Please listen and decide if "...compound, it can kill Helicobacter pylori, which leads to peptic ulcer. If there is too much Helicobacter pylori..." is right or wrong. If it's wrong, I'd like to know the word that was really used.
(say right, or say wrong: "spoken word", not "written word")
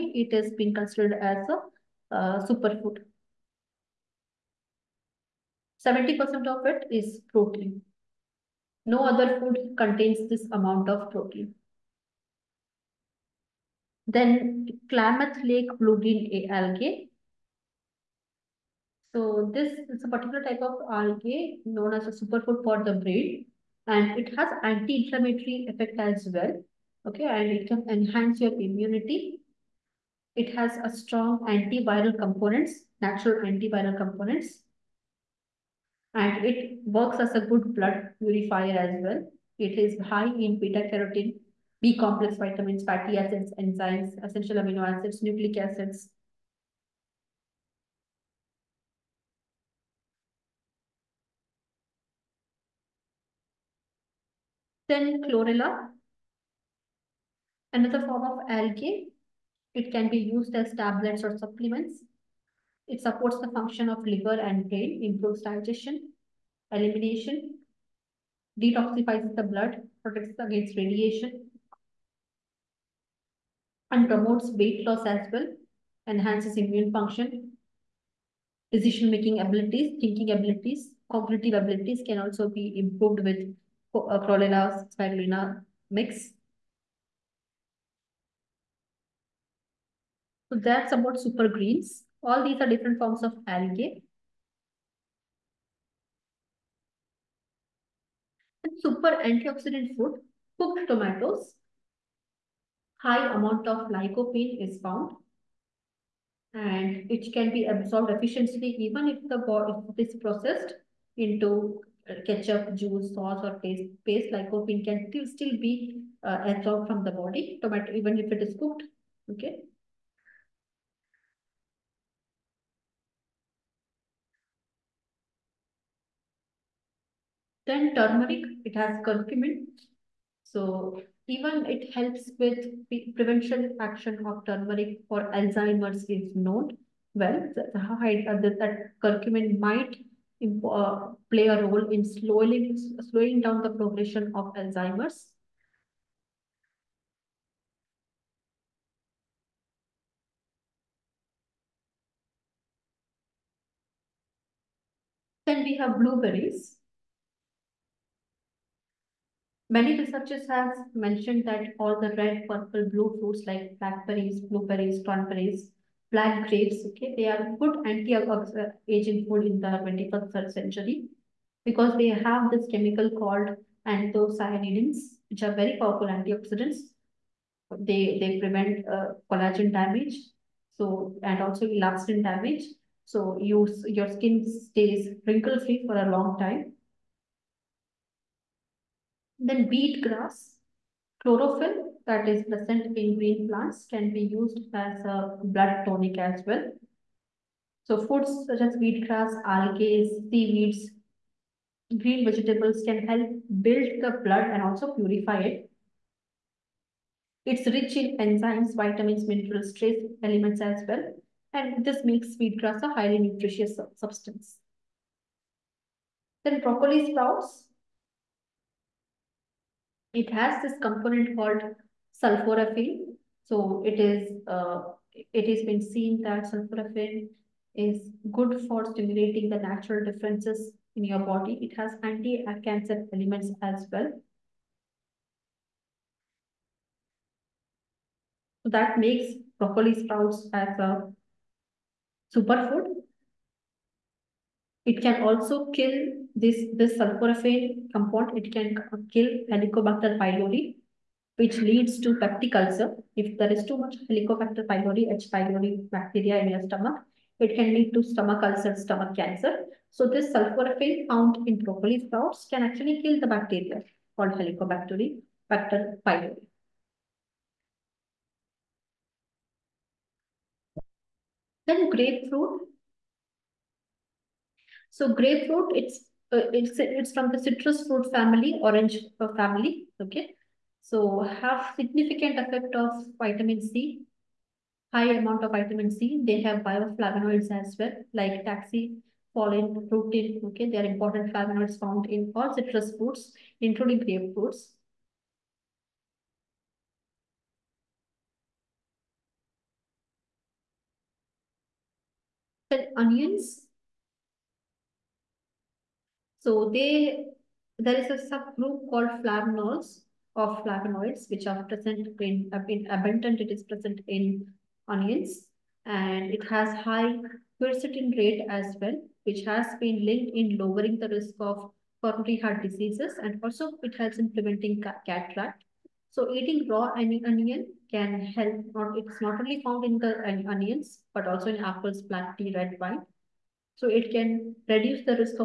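right.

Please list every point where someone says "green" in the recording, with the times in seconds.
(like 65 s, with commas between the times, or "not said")
15 s, 91 s, 193 s, 202 s.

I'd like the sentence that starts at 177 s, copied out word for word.
They, they prevent uh, collagen damage so and also elastin damage.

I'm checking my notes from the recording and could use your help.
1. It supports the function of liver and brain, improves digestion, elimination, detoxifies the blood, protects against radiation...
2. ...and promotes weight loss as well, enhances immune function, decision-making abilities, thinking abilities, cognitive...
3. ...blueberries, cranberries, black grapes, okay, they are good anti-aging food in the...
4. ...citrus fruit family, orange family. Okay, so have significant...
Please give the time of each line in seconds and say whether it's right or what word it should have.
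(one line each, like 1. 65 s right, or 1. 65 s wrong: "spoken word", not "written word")
1. 62 s right
2. 73 s right
3. 164 s right
4. 277 s right.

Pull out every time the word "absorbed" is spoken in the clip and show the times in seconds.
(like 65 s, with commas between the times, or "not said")
107 s, 116 s.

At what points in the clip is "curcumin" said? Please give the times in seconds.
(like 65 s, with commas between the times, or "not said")
129 s, 139 s.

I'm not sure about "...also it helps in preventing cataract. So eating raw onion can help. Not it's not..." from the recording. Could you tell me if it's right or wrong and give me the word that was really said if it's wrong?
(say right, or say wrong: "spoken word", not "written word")
right.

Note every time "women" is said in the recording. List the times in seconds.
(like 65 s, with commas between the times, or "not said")
not said.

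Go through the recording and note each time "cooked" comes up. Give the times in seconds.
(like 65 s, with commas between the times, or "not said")
100 s, 118 s.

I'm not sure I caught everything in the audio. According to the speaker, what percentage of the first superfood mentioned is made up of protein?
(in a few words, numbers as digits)
70%.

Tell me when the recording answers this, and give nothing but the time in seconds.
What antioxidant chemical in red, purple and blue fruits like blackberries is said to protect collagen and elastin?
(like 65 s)
173 s.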